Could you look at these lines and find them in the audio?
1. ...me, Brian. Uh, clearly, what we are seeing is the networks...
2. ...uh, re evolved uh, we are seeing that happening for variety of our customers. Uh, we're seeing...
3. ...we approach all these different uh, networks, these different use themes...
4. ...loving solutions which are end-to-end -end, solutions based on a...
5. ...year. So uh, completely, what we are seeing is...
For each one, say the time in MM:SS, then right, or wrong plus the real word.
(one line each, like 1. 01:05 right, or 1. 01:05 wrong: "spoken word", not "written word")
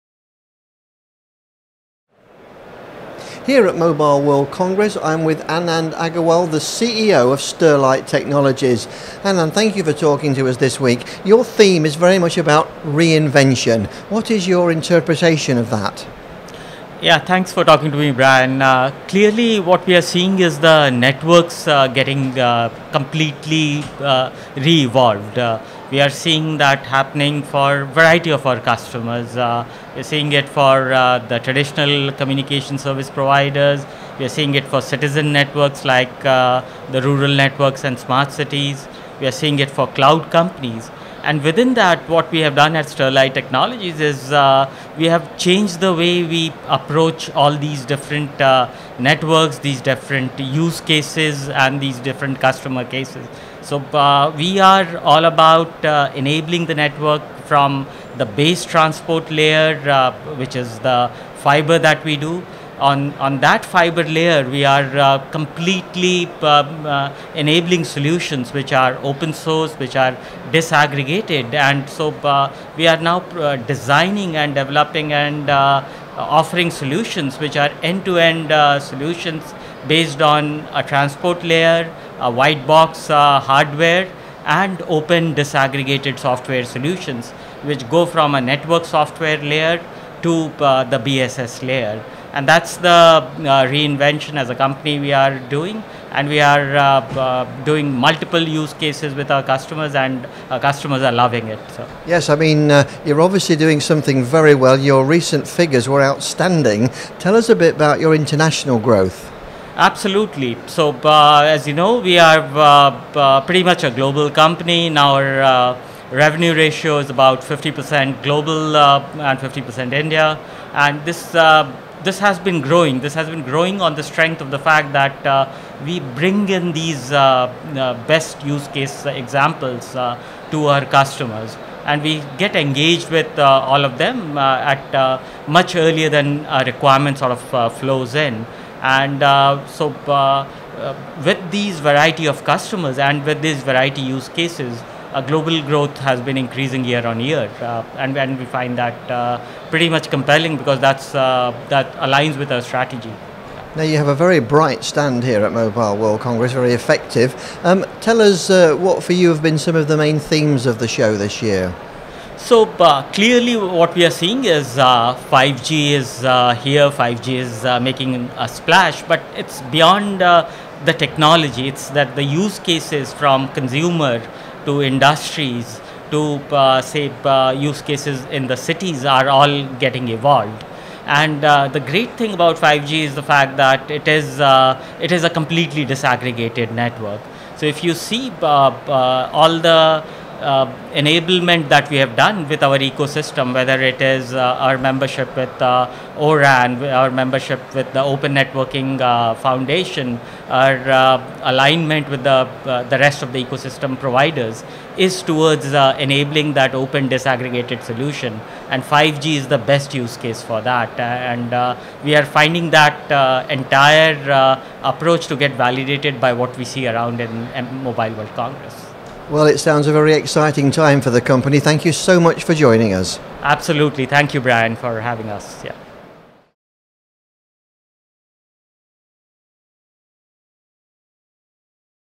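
1. 00:17 right
2. 00:24 right
3. 00:46 wrong: "cases", not "themes"
4. 01:16 wrong: "offering", not "loving"
5. 02:41 wrong: "clearly", not "completely".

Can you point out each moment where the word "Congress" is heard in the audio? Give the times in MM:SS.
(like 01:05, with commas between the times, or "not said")
00:04, 02:36, 03:38.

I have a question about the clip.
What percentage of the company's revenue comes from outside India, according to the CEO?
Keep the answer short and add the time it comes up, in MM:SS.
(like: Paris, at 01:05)
50%, at 01:57.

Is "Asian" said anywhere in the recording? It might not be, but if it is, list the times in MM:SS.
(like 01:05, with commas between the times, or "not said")
not said.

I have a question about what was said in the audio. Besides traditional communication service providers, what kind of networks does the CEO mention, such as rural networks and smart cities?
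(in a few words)
Citizen networks.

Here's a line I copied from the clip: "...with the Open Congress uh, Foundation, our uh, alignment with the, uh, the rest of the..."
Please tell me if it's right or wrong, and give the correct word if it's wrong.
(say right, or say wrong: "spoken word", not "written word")
wrong: "Networking", not "Congress".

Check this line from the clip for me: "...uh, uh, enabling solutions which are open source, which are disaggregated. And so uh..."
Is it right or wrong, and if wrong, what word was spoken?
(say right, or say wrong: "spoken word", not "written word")
right.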